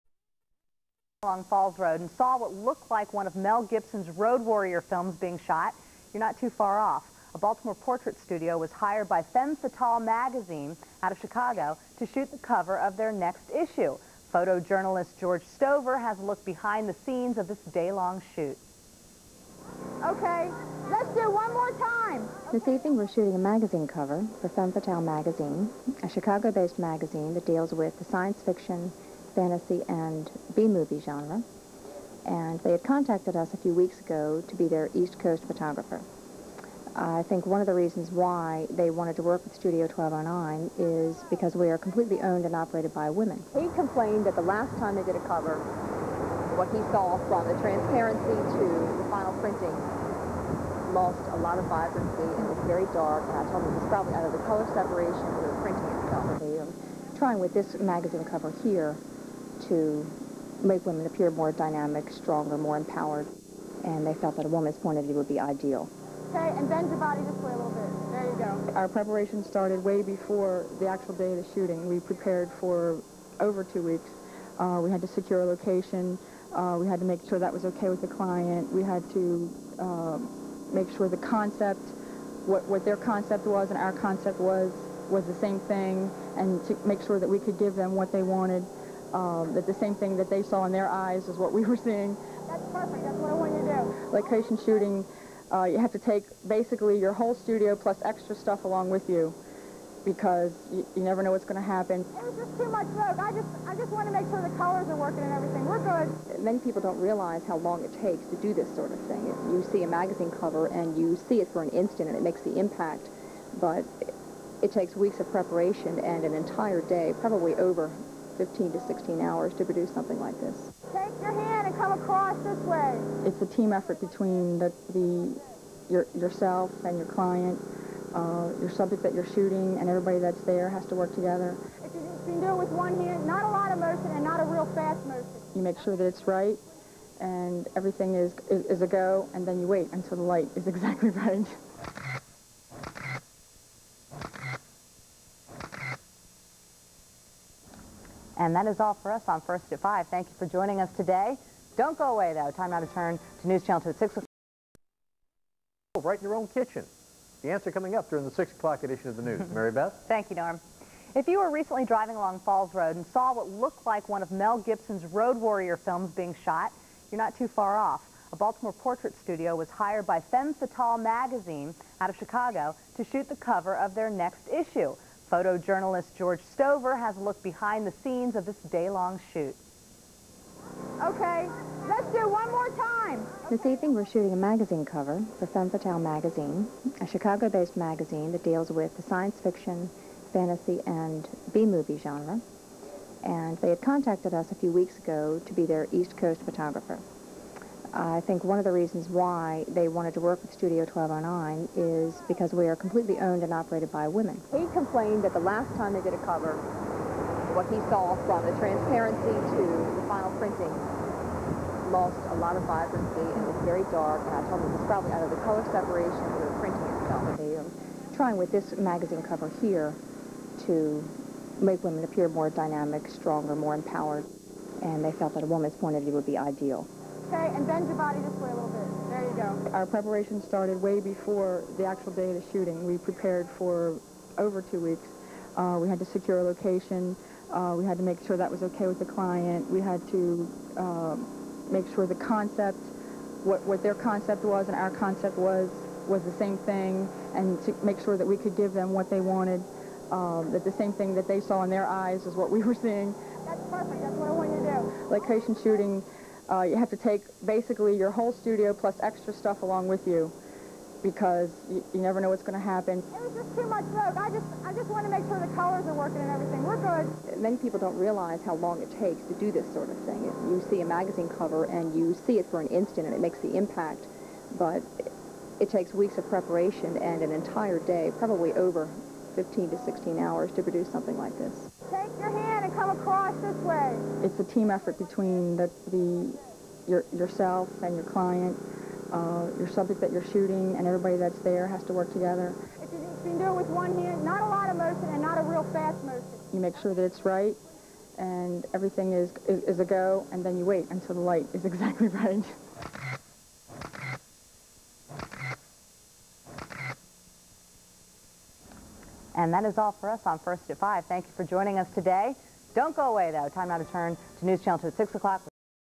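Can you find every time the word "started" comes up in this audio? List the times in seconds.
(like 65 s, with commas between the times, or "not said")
69 s, 230 s.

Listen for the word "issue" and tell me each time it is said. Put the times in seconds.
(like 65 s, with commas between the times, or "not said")
13 s, 174 s.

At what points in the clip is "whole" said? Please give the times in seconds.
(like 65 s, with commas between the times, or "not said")
97 s, 258 s.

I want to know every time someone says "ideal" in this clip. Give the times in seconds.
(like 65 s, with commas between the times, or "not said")
65 s, 226 s.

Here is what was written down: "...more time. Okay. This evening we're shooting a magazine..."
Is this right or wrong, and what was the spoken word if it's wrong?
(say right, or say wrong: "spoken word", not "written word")
right.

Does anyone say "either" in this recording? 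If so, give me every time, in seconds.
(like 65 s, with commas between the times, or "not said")
54 s, 215 s.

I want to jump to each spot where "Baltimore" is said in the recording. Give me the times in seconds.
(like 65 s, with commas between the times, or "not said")
7 s, 168 s.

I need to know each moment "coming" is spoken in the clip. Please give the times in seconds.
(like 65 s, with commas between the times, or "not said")
157 s.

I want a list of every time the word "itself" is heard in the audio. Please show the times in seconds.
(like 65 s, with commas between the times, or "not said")
56 s, 217 s.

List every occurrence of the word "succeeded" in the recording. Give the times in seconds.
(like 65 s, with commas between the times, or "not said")
not said.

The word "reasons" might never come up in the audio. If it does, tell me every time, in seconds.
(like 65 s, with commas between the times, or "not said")
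37 s, 198 s.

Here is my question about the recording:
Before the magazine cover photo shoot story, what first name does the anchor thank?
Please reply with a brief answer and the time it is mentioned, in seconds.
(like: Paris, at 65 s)
Norm, at 160 s.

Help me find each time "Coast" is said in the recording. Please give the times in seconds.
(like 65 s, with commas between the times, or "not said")
35 s, 196 s.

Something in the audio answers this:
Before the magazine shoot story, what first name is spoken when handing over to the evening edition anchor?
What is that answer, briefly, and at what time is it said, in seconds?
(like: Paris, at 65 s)
Mary Beth, at 159 s.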